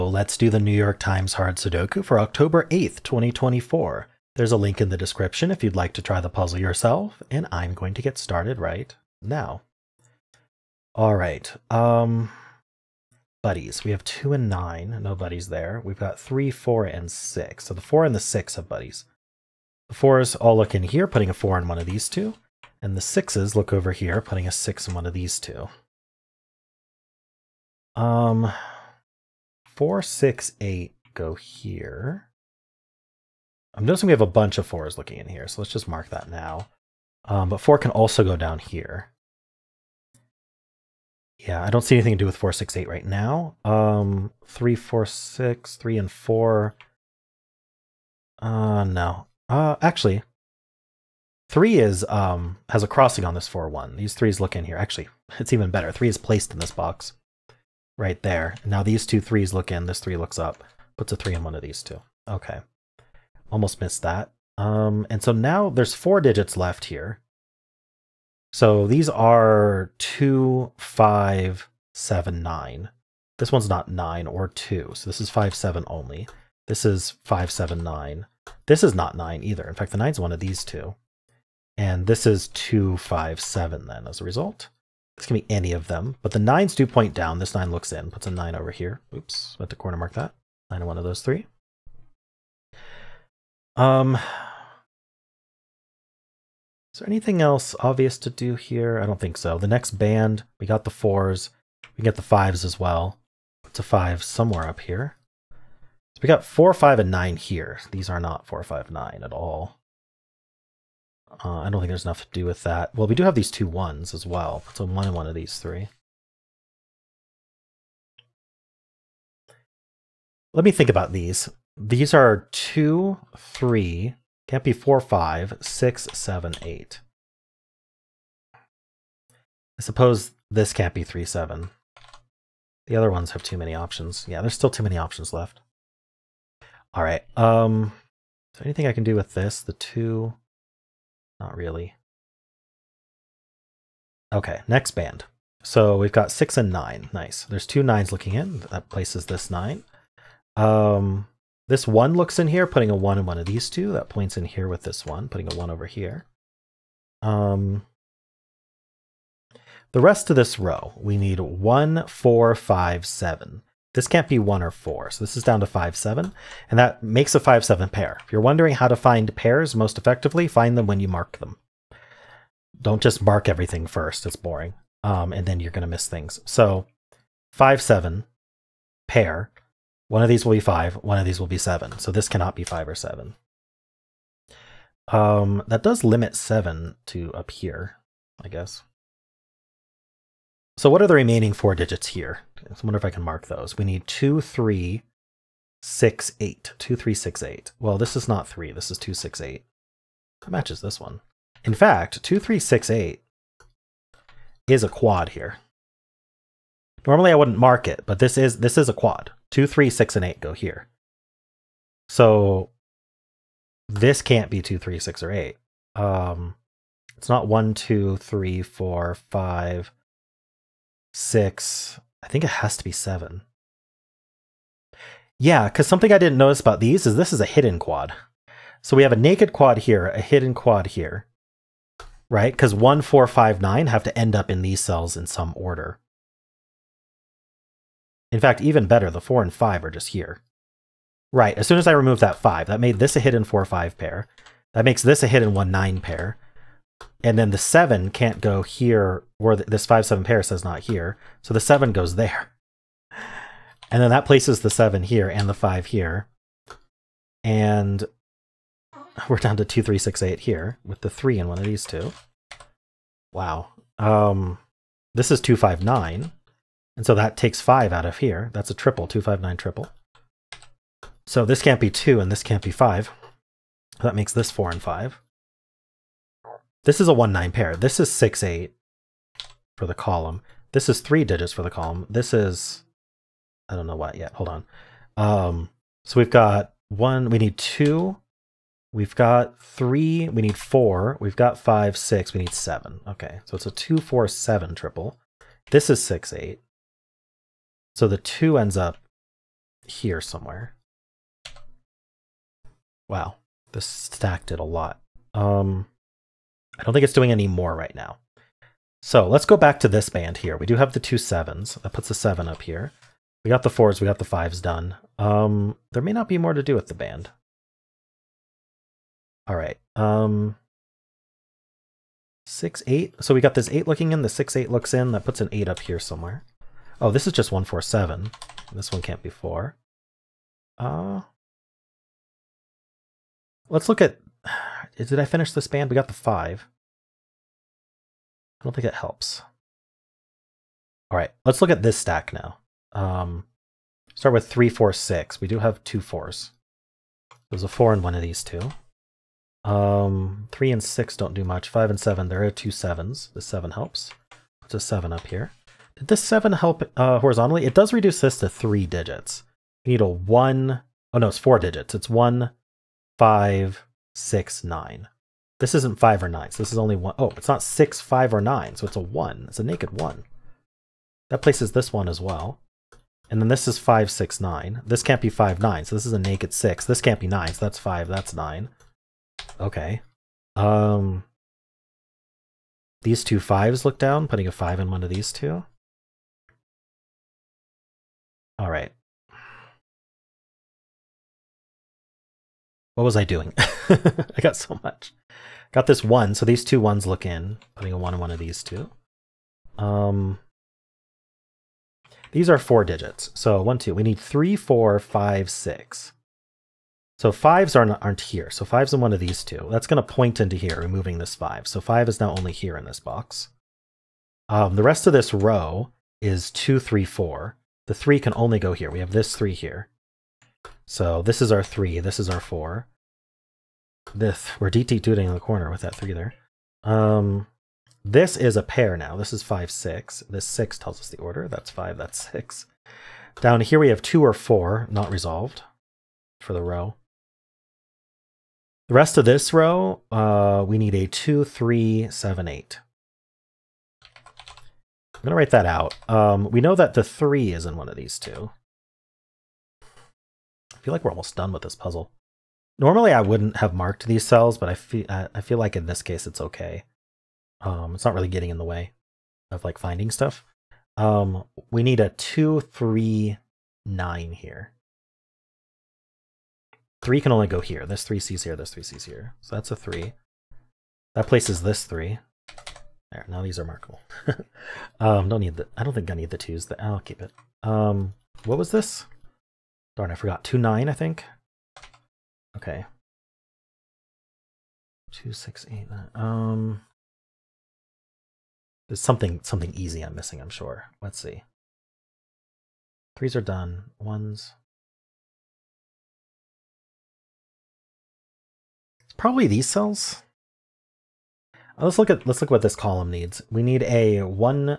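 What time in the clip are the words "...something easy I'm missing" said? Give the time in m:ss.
8:09.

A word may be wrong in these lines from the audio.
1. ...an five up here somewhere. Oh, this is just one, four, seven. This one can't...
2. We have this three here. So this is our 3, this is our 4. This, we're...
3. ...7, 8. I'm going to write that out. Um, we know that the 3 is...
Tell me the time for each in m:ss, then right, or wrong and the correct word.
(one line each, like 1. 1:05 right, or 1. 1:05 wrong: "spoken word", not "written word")
1. 5:25 wrong: "eight", not "five"
2. 6:58 right
3. 7:22 right.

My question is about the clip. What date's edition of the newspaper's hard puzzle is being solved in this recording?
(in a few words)
October 8th, 2024.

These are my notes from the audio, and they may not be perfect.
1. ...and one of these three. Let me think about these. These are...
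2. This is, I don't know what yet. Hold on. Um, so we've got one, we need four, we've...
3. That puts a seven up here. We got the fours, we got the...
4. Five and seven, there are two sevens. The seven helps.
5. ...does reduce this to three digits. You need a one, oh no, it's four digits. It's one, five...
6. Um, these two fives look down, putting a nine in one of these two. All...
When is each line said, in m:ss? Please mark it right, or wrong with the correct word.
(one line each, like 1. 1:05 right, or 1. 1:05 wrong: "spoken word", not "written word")
1. 1:55 right
2. 4:42 wrong: "two", not "four"
3. 5:11 right
4. 5:51 right
5. 5:57 right
6. 6:20 wrong: "five", not "nine".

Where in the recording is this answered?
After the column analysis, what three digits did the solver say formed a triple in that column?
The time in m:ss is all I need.
4:53.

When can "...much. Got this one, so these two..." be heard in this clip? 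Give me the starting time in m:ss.
6:34.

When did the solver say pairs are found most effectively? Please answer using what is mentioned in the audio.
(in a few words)
When you mark them.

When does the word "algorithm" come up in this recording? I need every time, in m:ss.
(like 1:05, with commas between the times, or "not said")
not said.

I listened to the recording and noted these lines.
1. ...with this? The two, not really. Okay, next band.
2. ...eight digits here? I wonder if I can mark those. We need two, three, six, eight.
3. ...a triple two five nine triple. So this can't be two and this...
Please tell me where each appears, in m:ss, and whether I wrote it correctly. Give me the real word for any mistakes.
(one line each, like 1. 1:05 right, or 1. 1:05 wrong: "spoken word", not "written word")
1. 2:19 right
2. 3:11 wrong: "four", not "eight"
3. 4:28 right.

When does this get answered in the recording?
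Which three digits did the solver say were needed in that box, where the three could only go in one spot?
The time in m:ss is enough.
7:42.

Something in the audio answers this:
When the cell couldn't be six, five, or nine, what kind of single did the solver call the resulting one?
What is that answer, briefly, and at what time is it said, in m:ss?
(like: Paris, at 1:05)
Naked one, at 6:09.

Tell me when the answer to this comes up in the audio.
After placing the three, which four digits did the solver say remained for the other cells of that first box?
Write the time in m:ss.
1:09.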